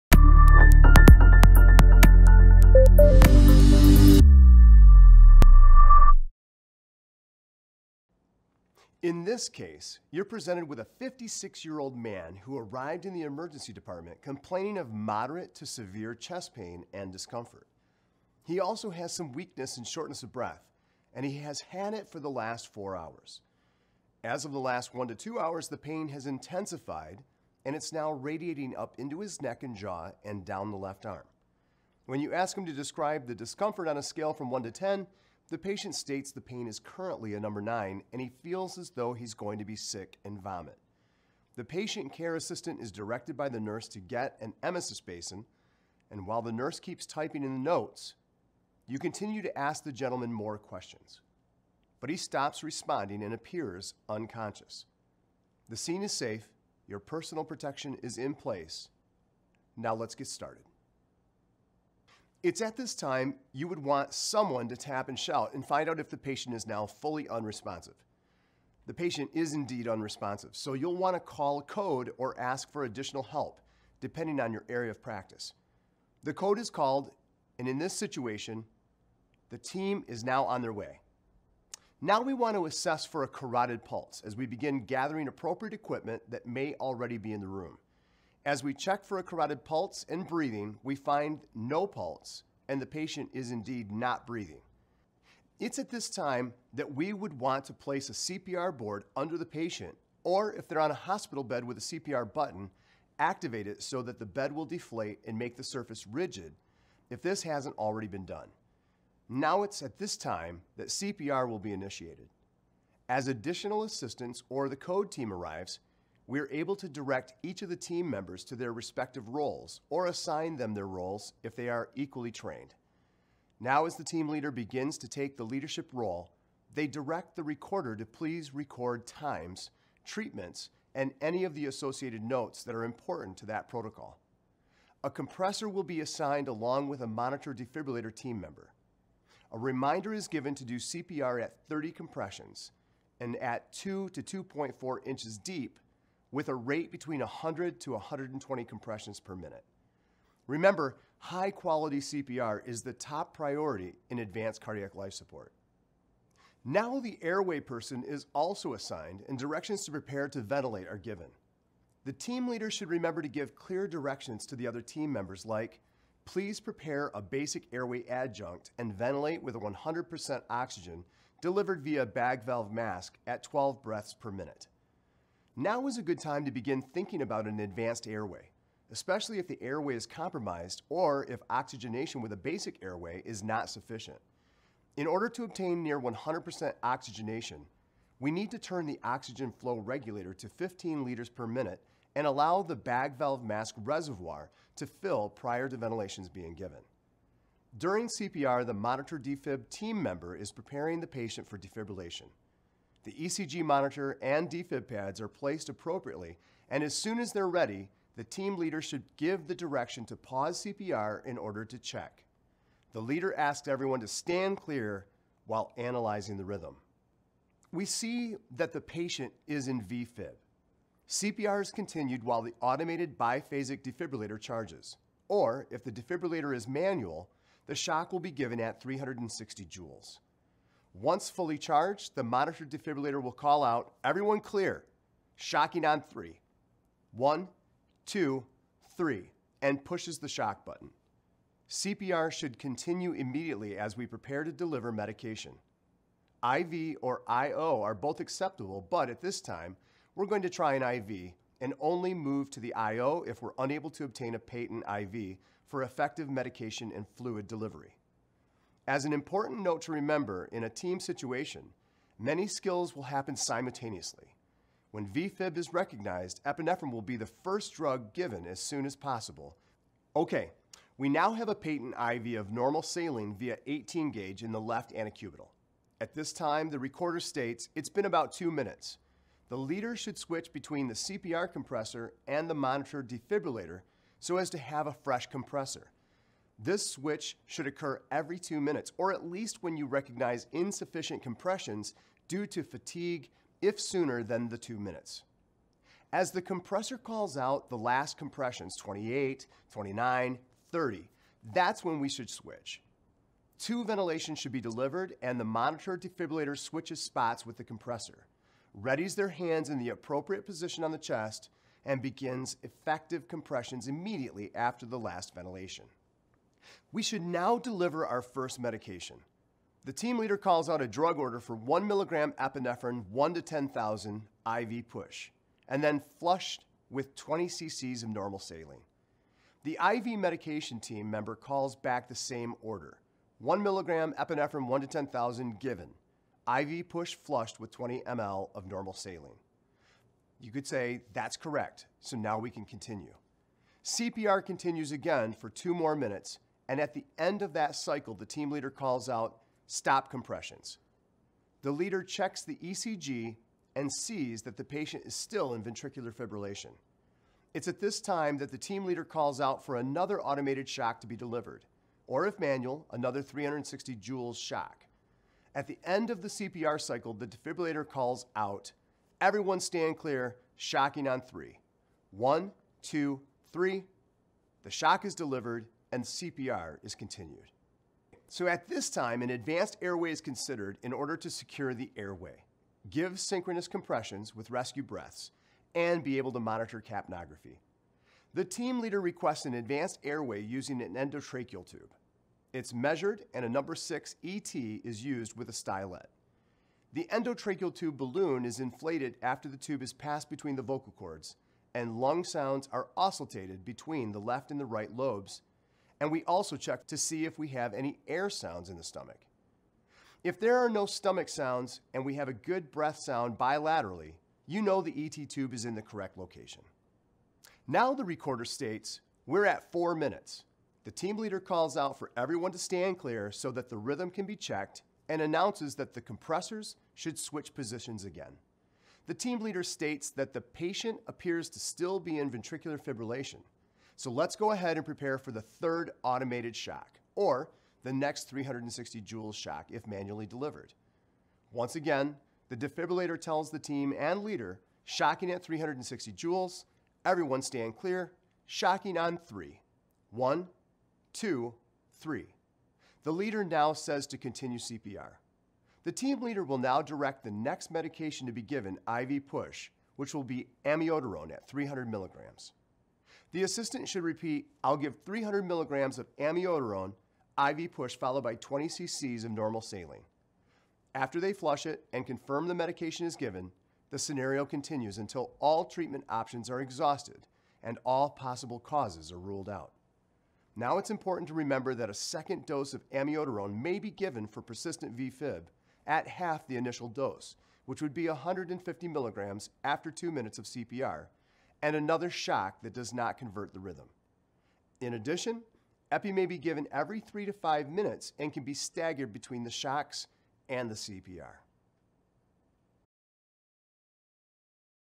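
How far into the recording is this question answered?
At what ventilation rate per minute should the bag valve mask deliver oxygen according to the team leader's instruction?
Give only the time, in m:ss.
2:53.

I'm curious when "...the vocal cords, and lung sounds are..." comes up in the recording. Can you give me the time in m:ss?
6:40.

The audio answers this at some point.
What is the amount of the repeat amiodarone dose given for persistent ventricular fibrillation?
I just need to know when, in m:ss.
8:08.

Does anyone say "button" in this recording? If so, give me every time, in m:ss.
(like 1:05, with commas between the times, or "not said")
1:42, 4:00.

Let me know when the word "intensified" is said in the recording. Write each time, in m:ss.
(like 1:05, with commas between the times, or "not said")
0:26.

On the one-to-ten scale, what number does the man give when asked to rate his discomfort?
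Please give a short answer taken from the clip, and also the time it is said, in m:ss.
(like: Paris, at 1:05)
9, at 0:37.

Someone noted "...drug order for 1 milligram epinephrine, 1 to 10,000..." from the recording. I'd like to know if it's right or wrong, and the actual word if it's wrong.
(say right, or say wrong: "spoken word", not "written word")
right.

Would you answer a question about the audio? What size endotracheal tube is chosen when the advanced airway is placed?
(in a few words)
number 6.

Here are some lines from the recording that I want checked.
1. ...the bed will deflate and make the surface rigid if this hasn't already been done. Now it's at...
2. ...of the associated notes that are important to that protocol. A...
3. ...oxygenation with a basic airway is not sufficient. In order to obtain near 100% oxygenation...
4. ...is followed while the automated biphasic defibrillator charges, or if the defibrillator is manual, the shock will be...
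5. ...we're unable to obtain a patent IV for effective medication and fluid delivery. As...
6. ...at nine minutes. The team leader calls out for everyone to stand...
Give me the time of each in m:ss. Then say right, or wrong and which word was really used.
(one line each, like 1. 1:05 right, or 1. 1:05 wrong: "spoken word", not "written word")
1. 1:44 right
2. 2:11 right
3. 3:01 right
4. 3:41 wrong: "continued", not "followed"
5. 4:13 right
6. 6:59 wrong: "four", not "nine".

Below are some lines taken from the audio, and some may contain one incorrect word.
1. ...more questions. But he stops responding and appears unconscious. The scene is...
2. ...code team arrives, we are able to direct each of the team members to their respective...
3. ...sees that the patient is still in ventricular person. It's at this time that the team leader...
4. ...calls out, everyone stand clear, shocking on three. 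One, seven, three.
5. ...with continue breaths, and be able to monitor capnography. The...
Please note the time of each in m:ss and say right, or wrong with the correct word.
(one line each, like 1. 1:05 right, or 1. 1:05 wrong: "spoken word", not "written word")
1. 0:50 right
2. 1:54 right
3. 5:53 wrong: "fibrillation", not "person"
4. 6:07 wrong: "two", not "seven"
5. 6:24 wrong: "rescue", not "continue".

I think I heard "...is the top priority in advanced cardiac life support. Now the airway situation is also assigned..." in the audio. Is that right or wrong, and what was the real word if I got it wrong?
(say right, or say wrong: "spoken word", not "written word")
wrong: "person", not "situation".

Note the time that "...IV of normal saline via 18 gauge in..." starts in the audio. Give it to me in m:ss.
4:31.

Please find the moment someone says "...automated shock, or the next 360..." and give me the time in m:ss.
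7:16.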